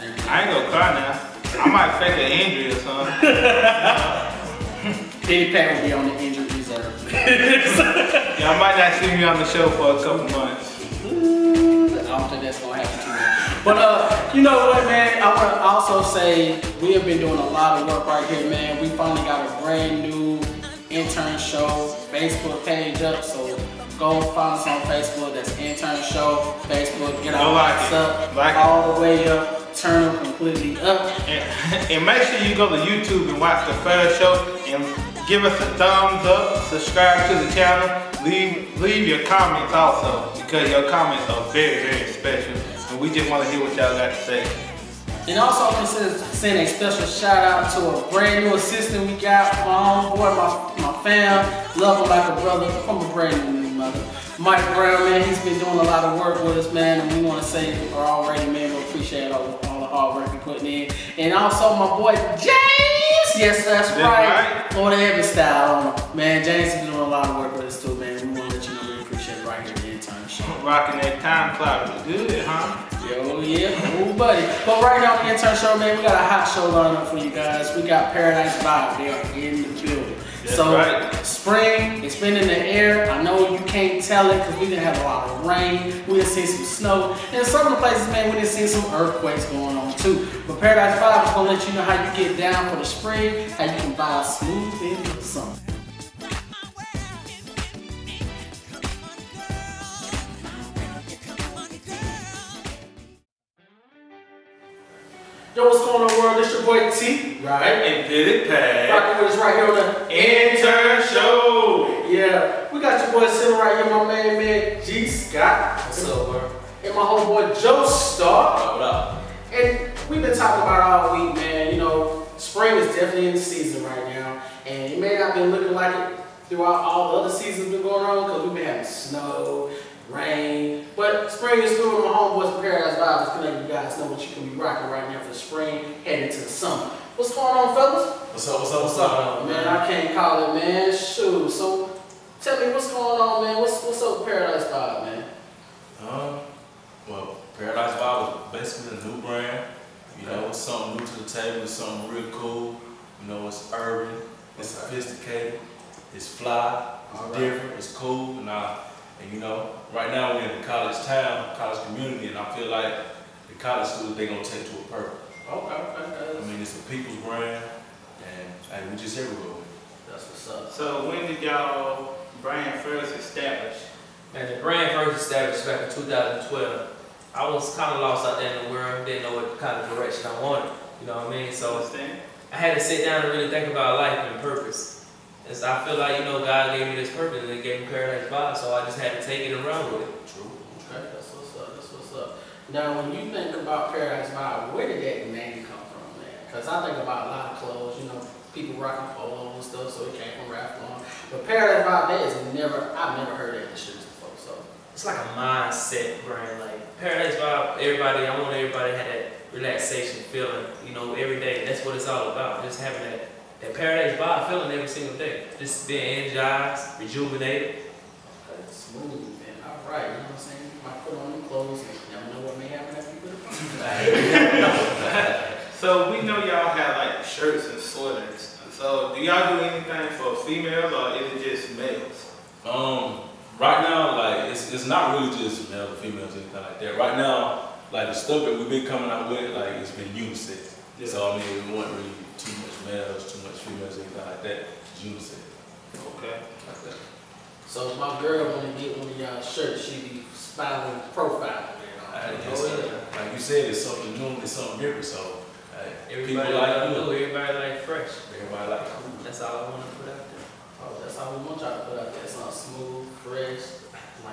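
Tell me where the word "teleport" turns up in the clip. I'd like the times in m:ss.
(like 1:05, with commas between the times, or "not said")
not said.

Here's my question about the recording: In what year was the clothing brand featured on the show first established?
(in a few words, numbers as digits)
2012.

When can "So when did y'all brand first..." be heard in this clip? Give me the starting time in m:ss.
2:50.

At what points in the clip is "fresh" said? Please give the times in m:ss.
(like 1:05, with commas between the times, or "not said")
4:17, 4:23.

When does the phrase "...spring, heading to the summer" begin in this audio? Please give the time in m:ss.
2:15.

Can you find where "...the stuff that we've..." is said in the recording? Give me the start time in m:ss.
3:58.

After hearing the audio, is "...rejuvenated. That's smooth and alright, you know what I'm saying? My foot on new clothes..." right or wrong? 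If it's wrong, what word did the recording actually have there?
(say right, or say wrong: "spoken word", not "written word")
right.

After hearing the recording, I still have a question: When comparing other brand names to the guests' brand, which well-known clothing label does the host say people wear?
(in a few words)
Polo.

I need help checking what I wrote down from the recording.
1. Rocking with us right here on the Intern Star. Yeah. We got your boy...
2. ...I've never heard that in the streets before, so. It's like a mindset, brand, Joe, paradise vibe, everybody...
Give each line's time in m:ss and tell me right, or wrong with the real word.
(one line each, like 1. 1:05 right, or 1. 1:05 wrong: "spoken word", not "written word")
1. 1:48 wrong: "Show", not "Star"
2. 3:22 wrong: "Like", not "Joe".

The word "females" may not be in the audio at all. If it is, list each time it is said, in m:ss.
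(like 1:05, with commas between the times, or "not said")
3:50, 3:55, 4:03.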